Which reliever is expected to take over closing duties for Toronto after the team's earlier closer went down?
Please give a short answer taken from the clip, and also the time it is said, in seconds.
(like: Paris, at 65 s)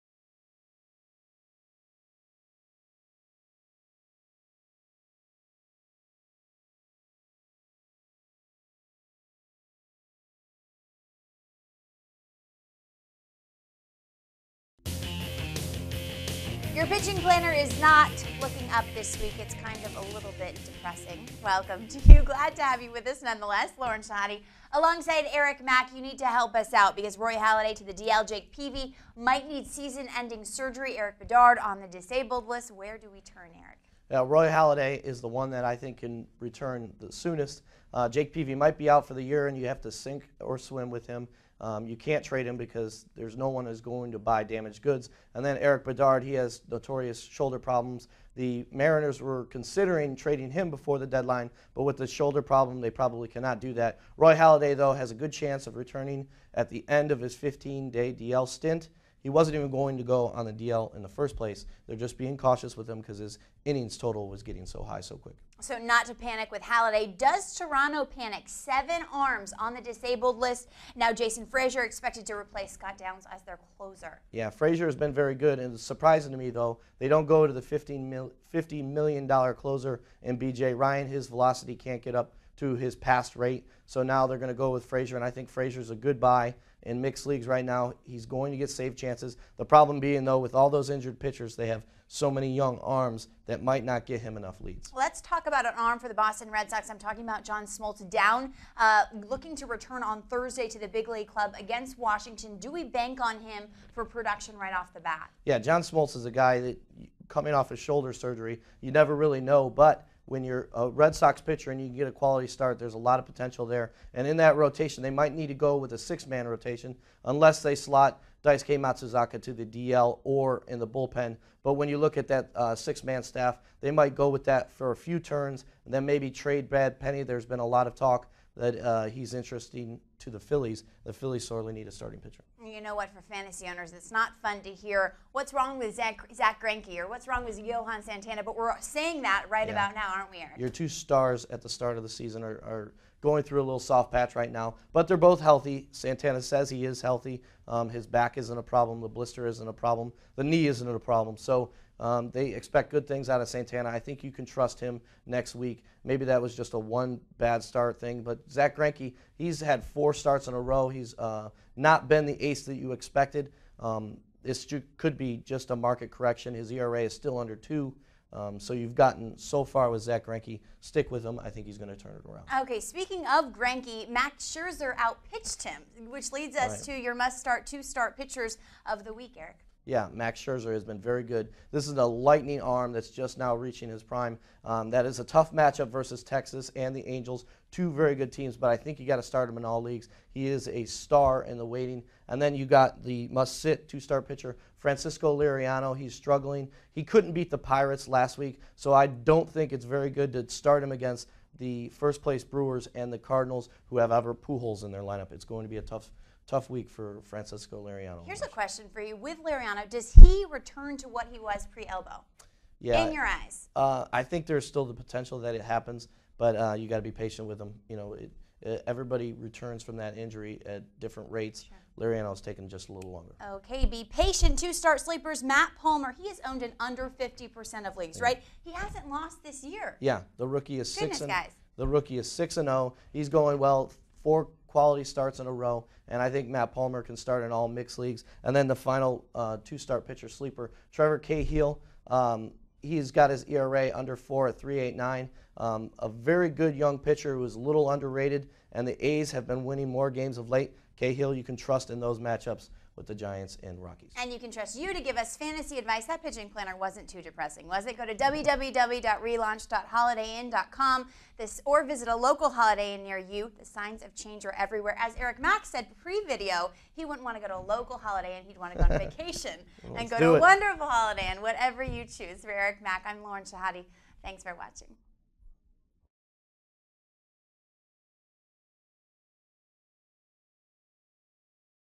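Jason Frasor, at 71 s.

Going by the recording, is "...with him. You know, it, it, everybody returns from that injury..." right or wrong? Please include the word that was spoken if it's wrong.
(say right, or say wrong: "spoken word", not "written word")
right.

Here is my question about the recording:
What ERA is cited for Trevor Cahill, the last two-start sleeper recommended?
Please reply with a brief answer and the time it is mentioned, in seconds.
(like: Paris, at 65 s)
3.89, at 244 s.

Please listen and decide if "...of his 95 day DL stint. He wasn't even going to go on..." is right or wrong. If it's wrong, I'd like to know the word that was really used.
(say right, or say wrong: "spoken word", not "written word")
wrong: "15", not "95".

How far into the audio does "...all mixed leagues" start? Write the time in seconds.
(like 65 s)
237 s.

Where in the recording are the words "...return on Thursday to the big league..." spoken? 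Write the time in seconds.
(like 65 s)
99 s.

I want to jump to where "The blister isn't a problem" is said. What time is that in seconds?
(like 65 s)
149 s.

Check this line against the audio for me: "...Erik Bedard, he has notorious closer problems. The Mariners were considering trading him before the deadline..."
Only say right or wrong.
wrong.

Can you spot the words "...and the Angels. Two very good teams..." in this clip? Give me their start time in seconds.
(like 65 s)
186 s.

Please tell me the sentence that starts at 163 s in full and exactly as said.
Um, this could be just a market correction.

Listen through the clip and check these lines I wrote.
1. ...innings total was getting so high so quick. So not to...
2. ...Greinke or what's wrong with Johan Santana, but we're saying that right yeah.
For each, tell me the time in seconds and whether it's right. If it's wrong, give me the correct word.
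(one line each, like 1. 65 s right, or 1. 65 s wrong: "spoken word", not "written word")
1. 63 s right
2. 136 s right.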